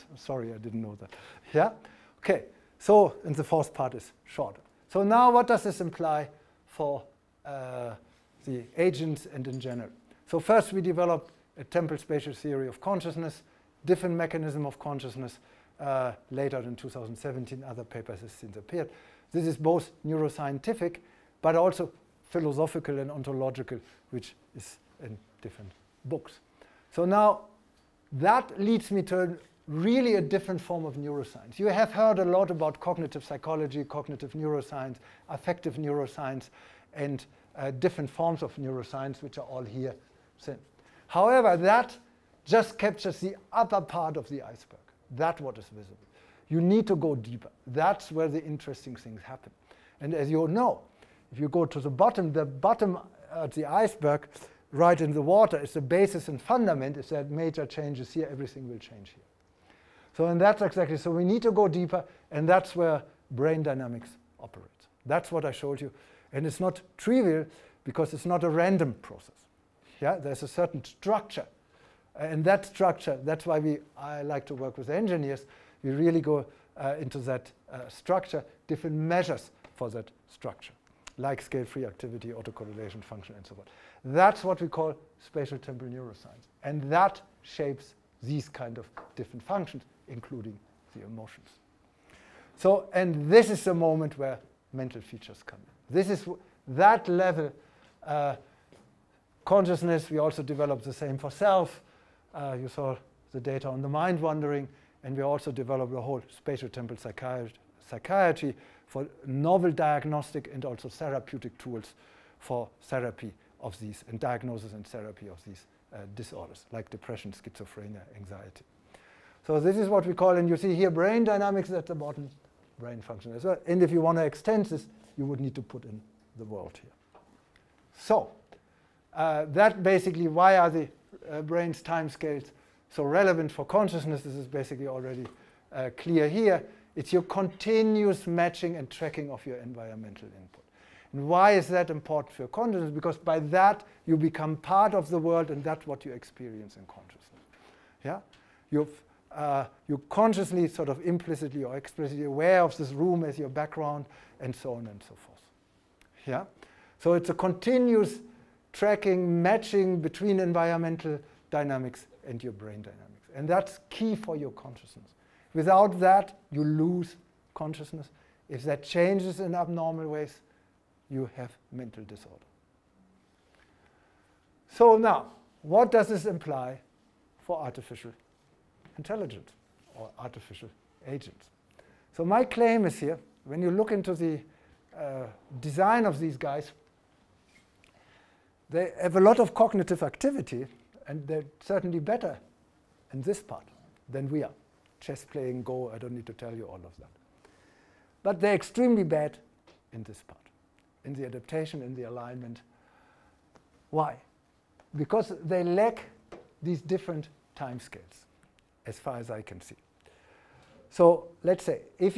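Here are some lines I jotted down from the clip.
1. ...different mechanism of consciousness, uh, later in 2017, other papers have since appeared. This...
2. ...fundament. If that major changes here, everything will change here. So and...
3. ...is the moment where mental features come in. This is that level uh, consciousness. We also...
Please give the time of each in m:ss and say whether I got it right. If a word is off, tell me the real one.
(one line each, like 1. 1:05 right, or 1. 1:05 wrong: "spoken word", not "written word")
1. 0:13 right
2. 0:56 right
3. 1:33 right.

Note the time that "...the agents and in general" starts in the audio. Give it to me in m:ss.
0:08.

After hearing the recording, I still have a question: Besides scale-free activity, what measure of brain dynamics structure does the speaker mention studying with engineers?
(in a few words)
autocorrelation function.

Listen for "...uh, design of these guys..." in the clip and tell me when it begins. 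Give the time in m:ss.
3:04.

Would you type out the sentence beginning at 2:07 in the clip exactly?
So uh, that basically, why are the uh, brain's time scales.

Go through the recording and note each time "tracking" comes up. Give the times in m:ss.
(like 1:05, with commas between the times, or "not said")
2:18, 2:38.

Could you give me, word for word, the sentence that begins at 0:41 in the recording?
However, that just captures the upper part of the iceberg.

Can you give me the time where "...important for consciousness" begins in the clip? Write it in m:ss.
2:21.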